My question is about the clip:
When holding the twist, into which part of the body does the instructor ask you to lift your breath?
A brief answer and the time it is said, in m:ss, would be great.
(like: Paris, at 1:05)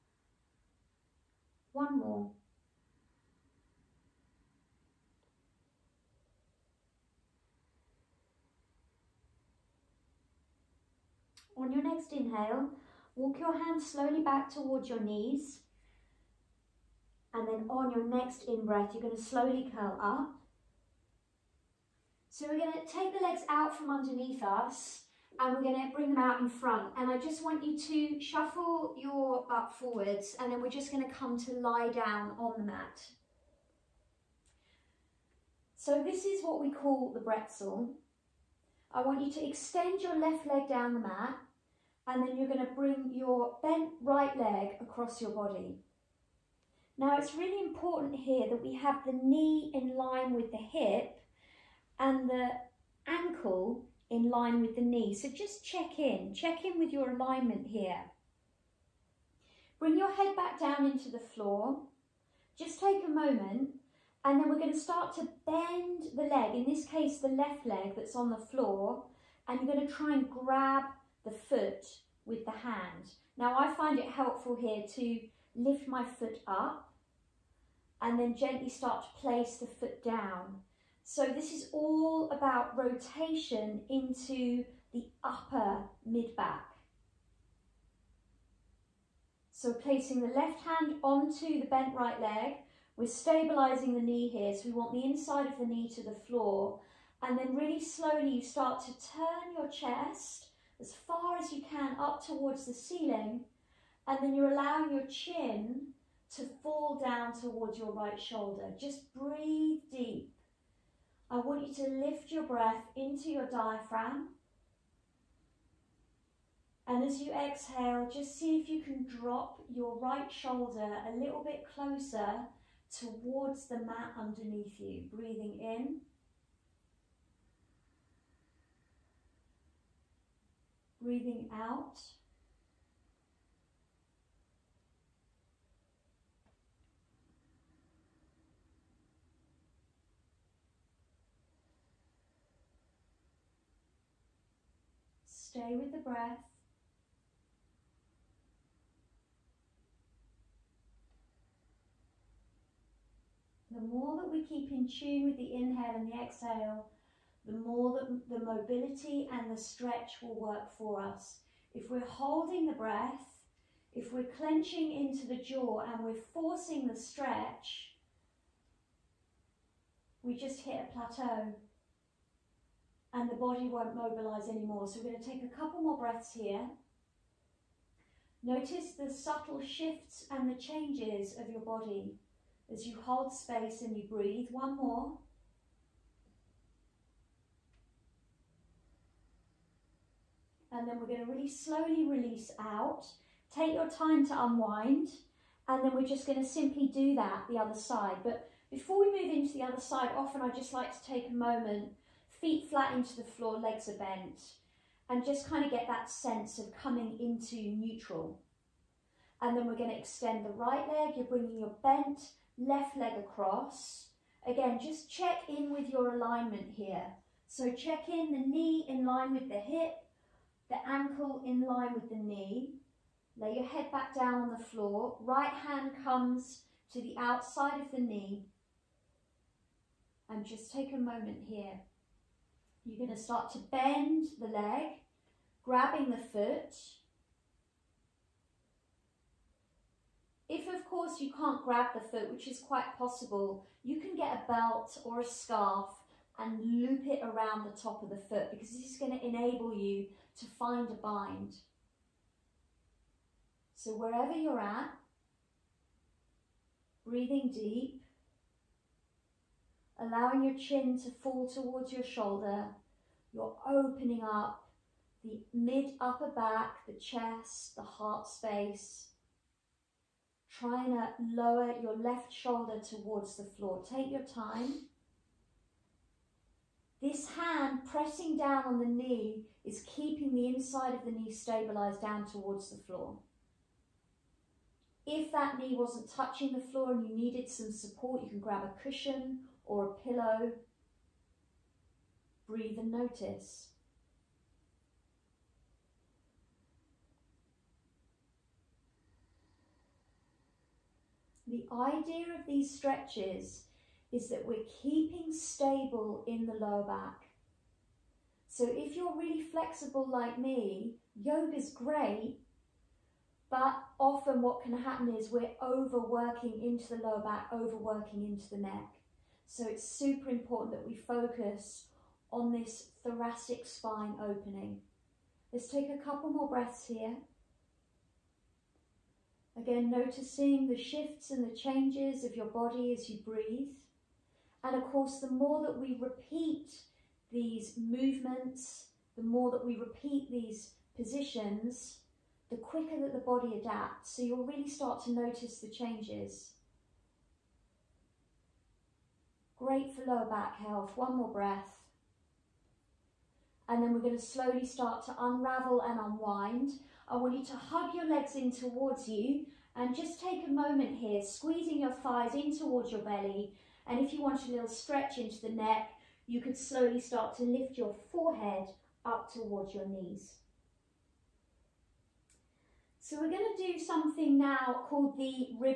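diaphragm, at 1:53.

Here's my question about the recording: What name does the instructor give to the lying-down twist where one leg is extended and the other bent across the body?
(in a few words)
the pretzel.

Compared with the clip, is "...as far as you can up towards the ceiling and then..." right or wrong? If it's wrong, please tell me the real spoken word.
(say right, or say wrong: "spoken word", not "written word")
right.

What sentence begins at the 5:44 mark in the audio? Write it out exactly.
So you'll really start to notice the changes.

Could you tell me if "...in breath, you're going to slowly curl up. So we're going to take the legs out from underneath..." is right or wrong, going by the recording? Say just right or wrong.
right.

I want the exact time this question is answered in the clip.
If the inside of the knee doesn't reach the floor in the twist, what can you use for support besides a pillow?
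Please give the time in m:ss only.
4:48.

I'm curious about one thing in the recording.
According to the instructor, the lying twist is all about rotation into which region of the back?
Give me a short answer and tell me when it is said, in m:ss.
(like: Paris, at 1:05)
upper mid-back, at 1:25.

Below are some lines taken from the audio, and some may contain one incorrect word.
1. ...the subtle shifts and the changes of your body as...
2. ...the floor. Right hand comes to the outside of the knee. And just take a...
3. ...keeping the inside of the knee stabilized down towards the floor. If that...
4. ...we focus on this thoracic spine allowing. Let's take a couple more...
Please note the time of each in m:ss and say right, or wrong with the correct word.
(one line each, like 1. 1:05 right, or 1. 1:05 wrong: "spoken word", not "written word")
1. 2:58 right
2. 3:44 right
3. 4:39 right
4. 5:20 wrong: "opening", not "allowing".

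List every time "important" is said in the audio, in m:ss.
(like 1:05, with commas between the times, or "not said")
0:47, 5:20.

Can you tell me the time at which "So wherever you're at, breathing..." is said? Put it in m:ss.
4:13.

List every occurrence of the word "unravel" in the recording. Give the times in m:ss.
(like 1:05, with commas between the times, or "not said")
5:55.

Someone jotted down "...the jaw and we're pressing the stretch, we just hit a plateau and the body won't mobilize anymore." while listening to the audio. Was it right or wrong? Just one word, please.
wrong.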